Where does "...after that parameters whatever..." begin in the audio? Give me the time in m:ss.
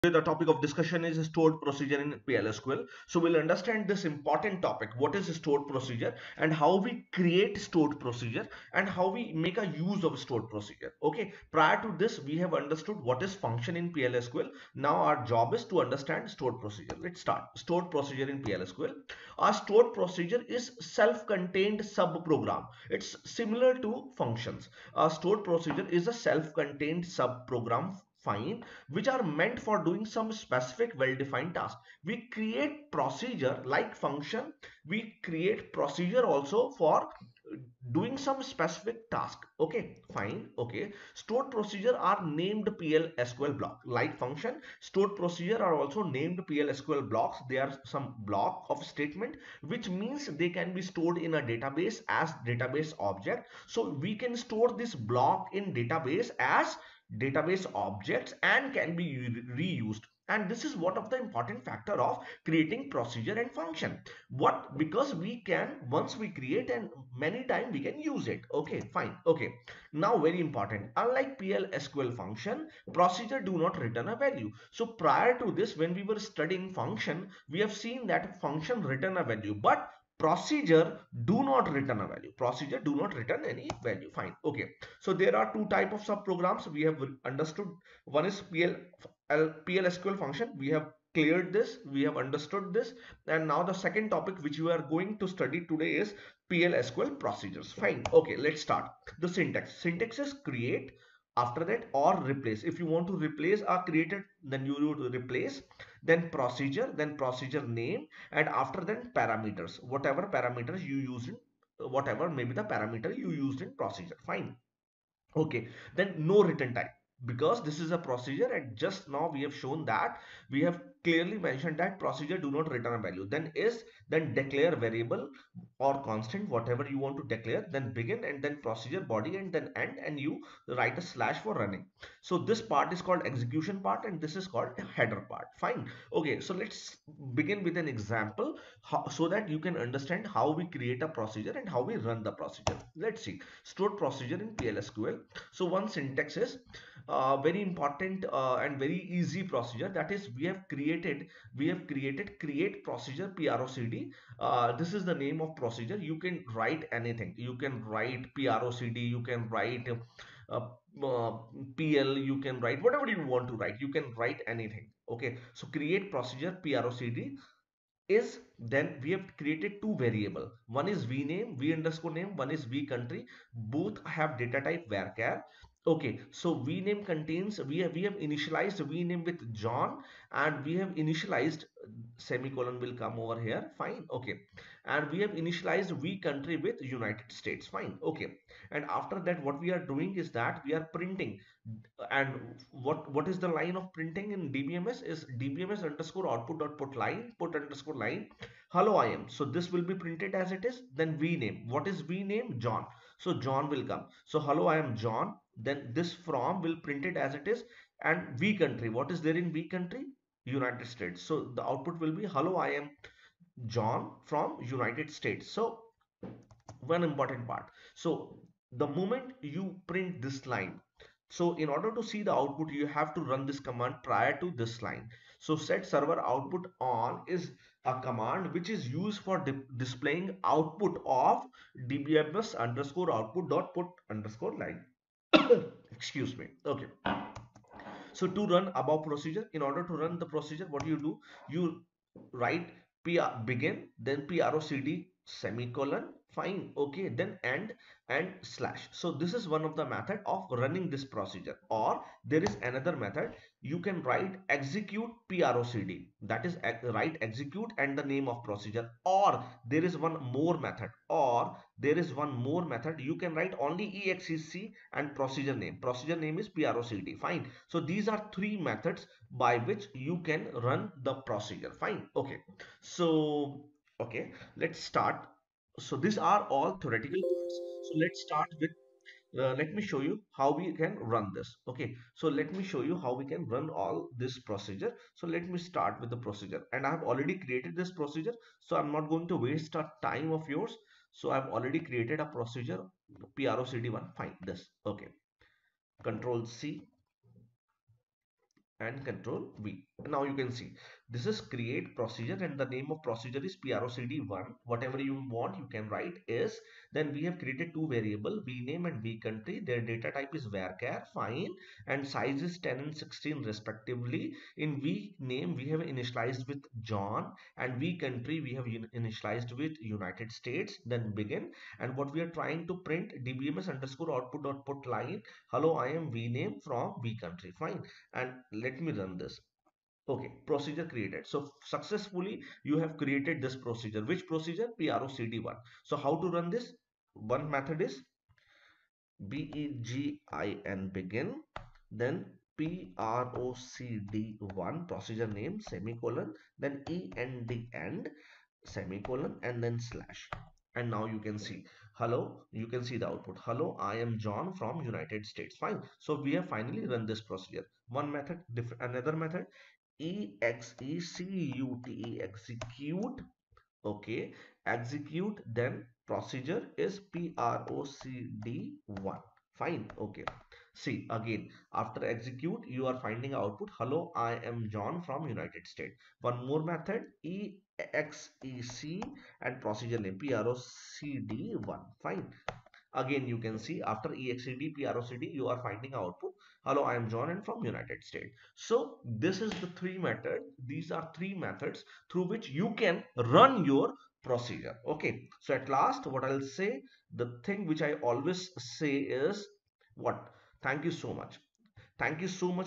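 1:48.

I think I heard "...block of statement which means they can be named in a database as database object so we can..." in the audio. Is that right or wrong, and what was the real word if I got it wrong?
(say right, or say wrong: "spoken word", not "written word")
wrong: "stored", not "named".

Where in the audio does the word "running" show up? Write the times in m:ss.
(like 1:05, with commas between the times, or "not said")
2:11, 4:10.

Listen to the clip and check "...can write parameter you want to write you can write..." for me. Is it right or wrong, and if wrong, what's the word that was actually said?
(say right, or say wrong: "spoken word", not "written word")
wrong: "whatever", not "parameter".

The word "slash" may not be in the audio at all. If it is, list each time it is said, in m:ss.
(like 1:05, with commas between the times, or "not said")
2:11, 4:08, 5:49.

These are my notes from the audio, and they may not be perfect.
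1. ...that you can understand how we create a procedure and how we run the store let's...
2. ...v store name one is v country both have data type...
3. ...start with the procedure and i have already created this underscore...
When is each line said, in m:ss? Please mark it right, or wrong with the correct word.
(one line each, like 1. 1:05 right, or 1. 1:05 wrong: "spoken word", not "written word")
1. 2:19 wrong: "procedure", not "store"
2. 2:51 wrong: "underscore", not "store"
3. 4:45 wrong: "procedure", not "underscore".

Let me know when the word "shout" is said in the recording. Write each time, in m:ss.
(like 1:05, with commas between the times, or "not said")
not said.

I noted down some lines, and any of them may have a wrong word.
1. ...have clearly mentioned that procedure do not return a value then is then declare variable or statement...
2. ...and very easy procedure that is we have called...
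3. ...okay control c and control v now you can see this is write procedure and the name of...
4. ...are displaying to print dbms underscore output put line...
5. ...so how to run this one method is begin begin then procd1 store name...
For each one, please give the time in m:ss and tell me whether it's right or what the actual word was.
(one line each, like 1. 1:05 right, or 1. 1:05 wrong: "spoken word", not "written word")
1. 2:00 wrong: "constant", not "statement"
2. 2:28 wrong: "created", not "called"
3. 4:54 wrong: "create", not "write"
4. 5:22 wrong: "trying", not "displaying"
5. 5:35 wrong: "procedure", not "store".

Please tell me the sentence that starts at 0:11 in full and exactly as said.
Okay, prior to this, we have understood what is function in PLSQL.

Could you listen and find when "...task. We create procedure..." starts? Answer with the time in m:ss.
0:31.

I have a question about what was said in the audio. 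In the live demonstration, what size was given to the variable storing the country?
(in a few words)
16.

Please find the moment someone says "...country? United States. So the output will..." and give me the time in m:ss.
3:29.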